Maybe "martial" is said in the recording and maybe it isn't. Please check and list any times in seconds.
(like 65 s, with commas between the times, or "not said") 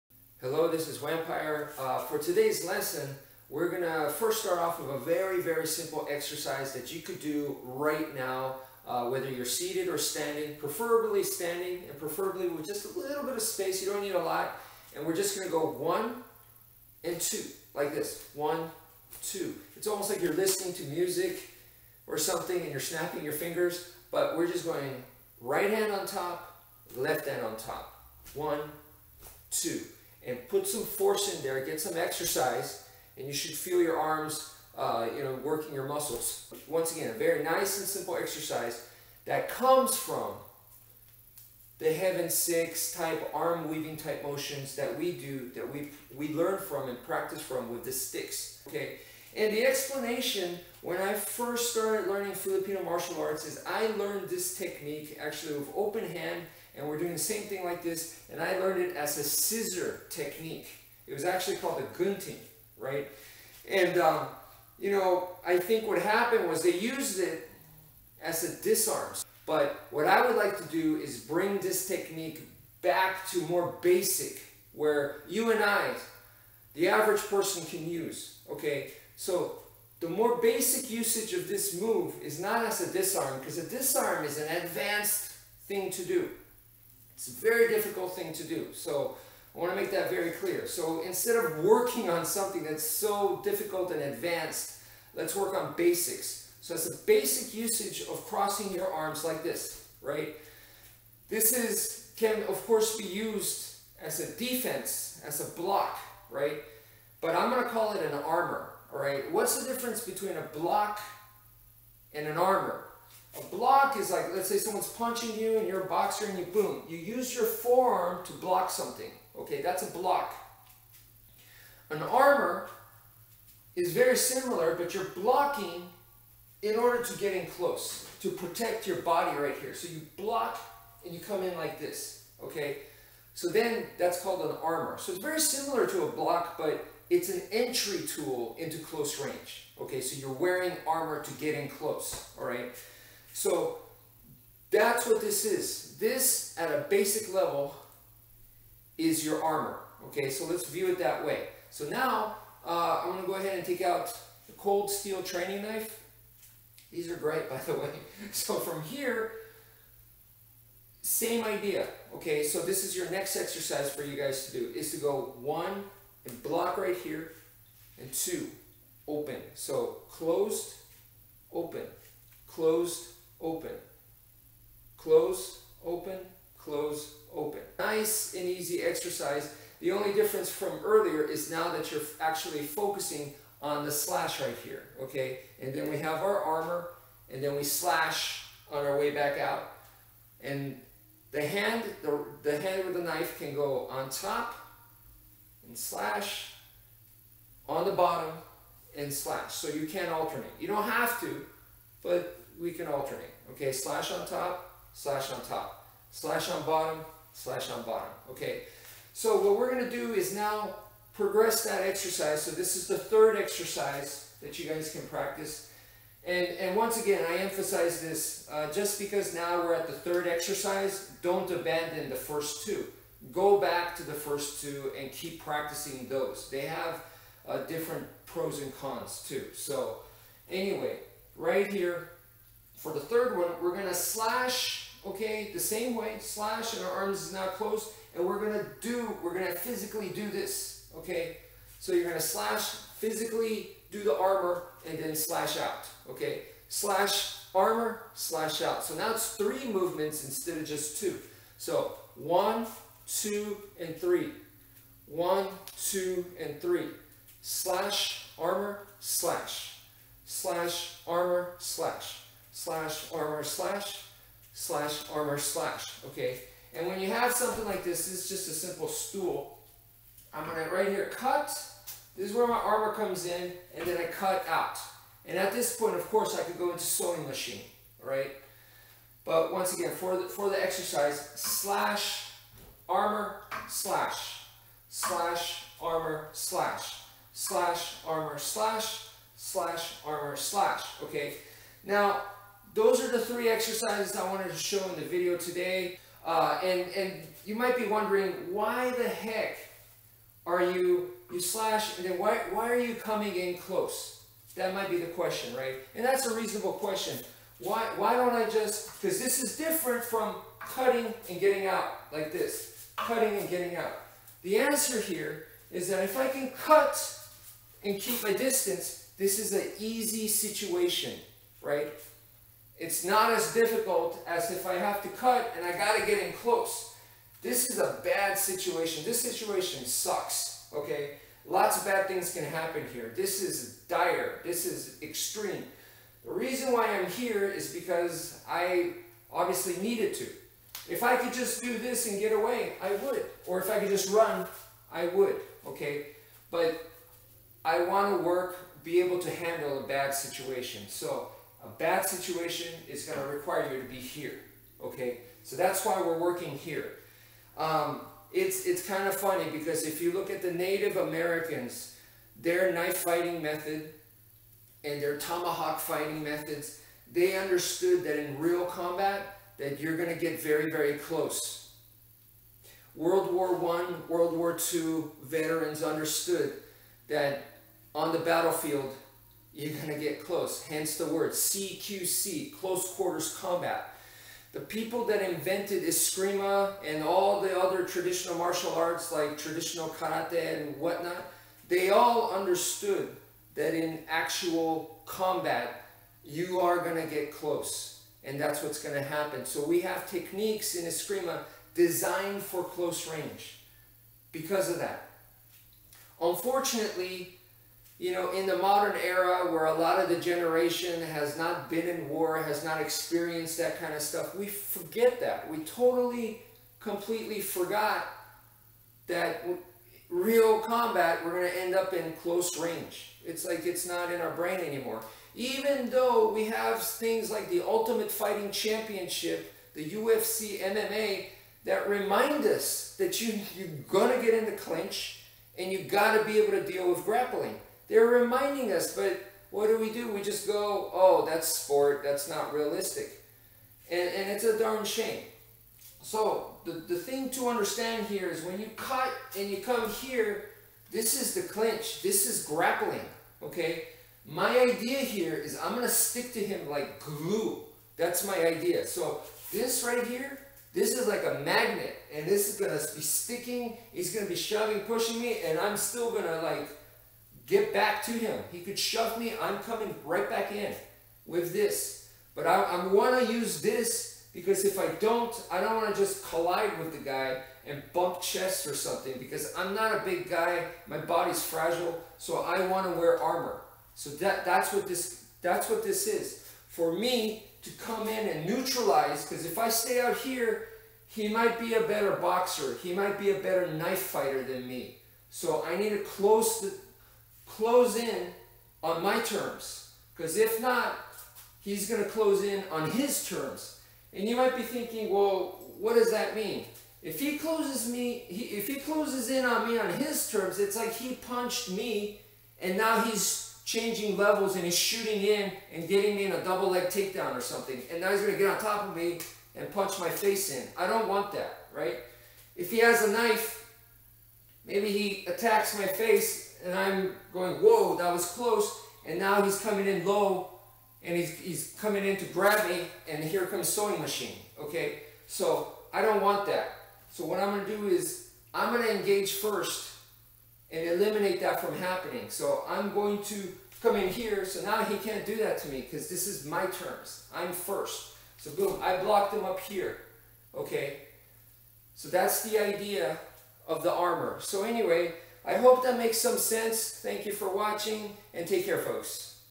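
52 s, 388 s.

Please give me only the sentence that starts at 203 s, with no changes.
Okay, slash on top, slash on top, slash on bottom, slash on bottom.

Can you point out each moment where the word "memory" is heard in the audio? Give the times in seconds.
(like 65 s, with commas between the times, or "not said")
not said.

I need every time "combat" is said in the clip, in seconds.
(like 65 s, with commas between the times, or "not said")
368 s, 383 s, 395 s, 420 s.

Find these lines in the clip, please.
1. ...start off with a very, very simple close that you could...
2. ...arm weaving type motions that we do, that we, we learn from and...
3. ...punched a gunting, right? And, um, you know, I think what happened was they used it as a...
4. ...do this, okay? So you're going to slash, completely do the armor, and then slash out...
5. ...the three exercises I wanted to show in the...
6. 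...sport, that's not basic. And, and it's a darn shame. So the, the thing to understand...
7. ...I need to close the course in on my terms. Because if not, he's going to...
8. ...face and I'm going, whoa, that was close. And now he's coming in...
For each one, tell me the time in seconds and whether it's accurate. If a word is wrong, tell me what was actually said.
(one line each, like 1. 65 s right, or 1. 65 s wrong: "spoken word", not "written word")
1. 4 s wrong: "exercise", not "close"
2. 43 s right
3. 61 s wrong: "called", not "punched"
4. 240 s wrong: "physically", not "completely"
5. 293 s right
6. 441 s wrong: "realistic", not "basic"
7. 495 s wrong: "close", not "course"
8. 525 s right.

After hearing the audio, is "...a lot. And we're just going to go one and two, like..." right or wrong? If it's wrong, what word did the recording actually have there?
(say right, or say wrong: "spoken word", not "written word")
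right.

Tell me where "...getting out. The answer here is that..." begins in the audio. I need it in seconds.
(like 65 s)
313 s.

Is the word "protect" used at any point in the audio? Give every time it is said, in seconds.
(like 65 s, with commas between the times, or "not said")
128 s.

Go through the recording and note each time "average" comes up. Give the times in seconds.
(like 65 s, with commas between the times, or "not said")
76 s.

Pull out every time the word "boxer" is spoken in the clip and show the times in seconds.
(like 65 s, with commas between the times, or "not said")
115 s, 492 s.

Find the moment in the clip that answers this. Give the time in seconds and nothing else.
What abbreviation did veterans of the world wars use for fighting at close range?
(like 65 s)
381 s.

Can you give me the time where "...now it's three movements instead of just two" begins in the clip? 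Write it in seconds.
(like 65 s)
248 s.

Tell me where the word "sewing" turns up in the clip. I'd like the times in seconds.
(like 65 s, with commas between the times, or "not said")
276 s, 533 s.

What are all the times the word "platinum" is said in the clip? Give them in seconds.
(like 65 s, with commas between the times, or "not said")
not said.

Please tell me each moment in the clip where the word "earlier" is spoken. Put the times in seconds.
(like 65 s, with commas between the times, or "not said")
180 s.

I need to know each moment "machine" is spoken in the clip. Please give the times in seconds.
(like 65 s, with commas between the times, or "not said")
277 s, 534 s.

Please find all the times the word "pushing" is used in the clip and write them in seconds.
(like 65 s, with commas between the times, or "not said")
464 s.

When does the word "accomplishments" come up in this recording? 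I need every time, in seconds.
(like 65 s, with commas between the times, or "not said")
not said.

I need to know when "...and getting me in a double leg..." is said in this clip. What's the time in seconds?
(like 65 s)
515 s.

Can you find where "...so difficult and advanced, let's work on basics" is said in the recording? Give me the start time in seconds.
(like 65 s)
92 s.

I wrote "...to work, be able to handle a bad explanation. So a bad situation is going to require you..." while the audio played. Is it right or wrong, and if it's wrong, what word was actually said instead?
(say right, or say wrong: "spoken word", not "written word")
wrong: "situation", not "explanation".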